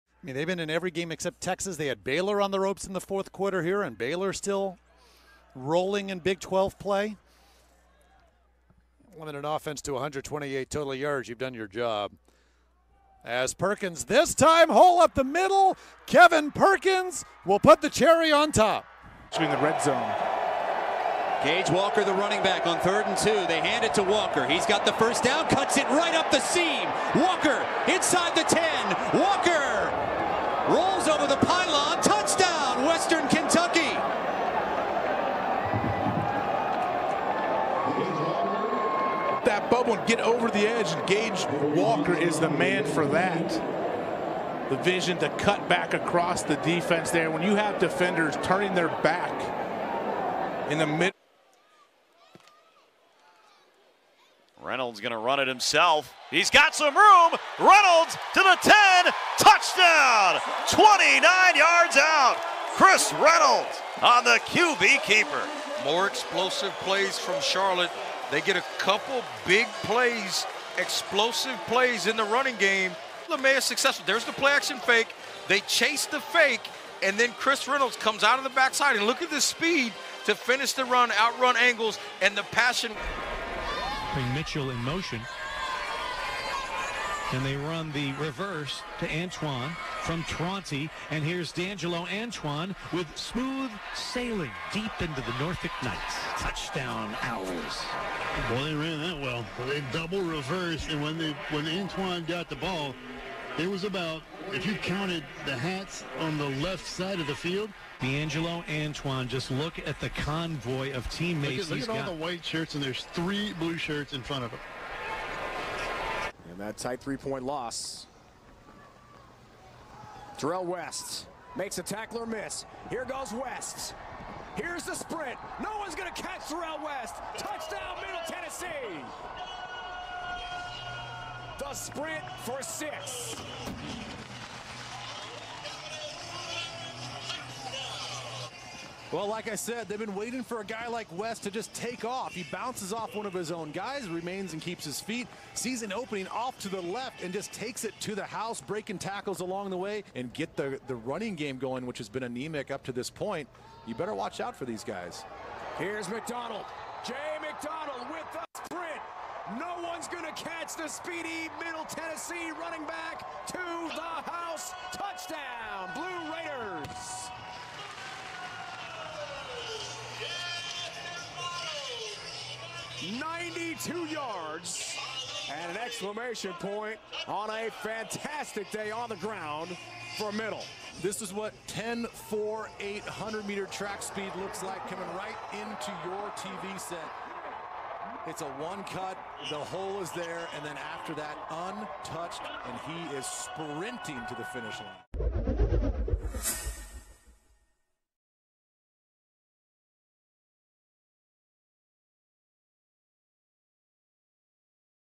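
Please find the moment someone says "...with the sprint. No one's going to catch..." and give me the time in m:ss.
2:38.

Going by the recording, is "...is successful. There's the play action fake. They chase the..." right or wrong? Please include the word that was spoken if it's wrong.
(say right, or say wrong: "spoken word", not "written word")
right.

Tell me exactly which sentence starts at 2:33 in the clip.
You better watch out for these guys.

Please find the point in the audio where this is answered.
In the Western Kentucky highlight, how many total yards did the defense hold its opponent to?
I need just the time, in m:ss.
0:09.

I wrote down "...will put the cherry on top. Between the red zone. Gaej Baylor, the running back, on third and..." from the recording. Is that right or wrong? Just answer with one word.
wrong.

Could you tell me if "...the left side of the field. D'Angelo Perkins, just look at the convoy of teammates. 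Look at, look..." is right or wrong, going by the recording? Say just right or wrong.
wrong.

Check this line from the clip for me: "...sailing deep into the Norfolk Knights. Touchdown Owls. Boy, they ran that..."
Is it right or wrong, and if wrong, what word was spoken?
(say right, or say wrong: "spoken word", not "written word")
right.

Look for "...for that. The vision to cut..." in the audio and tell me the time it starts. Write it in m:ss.
0:42.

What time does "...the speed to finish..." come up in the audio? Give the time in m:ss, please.
1:19.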